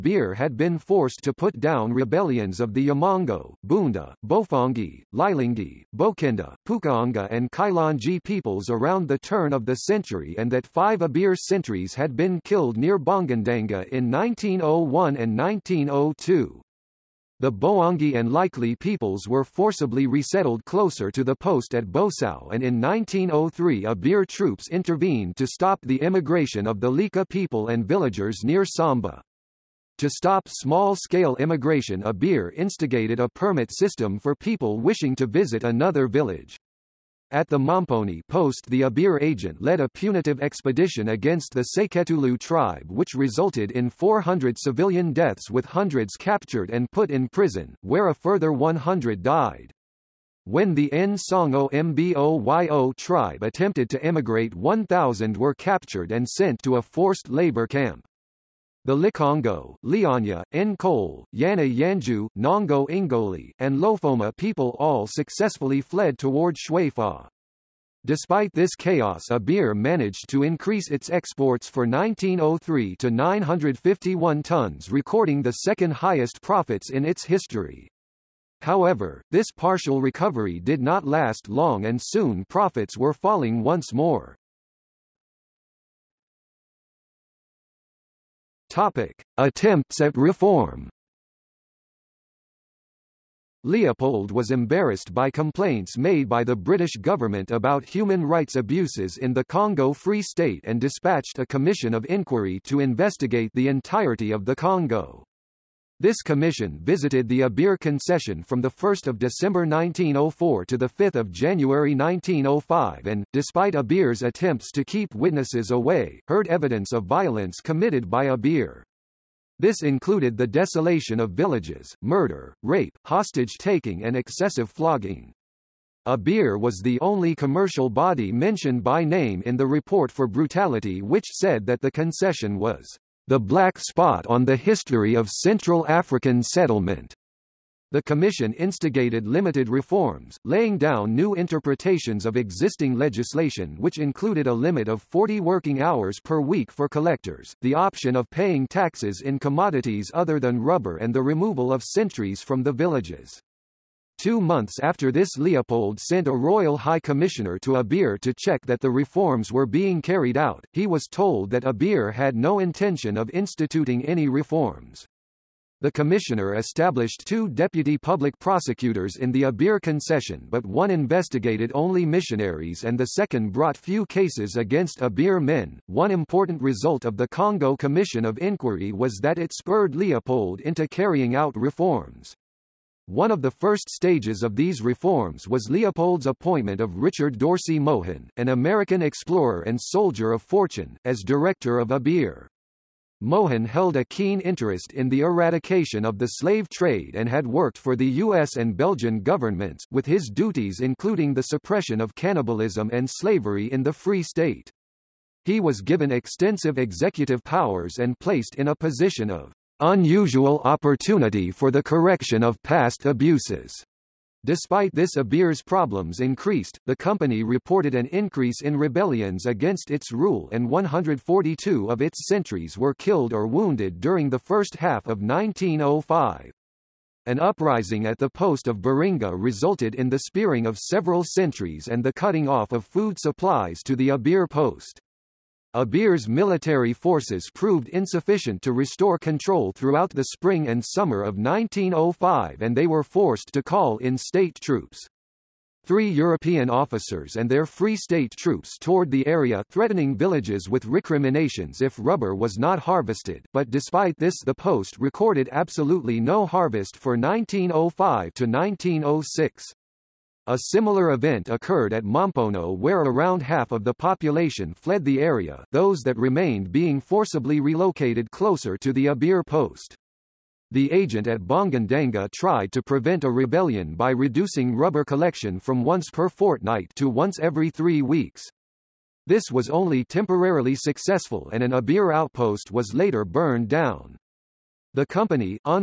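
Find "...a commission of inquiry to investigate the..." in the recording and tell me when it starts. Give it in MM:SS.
01:41.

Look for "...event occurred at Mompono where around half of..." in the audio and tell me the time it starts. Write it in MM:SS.
04:21.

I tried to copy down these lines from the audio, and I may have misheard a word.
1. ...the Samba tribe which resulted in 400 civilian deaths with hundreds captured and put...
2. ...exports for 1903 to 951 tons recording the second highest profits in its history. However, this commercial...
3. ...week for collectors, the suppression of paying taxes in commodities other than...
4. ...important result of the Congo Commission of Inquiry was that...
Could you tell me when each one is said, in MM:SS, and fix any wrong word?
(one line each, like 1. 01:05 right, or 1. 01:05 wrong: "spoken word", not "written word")
1. 00:41 wrong: "Seketulu", not "Samba"
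2. 01:11 wrong: "partial", not "commercial"
3. 02:26 wrong: "option", not "suppression"
4. 02:56 right.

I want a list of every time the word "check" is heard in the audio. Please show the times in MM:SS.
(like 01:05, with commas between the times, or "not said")
02:38.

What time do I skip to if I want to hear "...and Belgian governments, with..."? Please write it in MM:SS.
03:18.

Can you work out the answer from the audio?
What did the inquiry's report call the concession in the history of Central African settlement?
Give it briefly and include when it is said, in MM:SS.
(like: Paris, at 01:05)
the black spot, at 02:13.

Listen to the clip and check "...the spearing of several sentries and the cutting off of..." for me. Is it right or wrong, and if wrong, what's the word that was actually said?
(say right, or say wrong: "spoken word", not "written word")
right.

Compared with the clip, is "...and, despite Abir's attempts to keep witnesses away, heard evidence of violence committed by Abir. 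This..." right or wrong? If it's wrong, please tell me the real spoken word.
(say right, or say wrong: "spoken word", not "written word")
right.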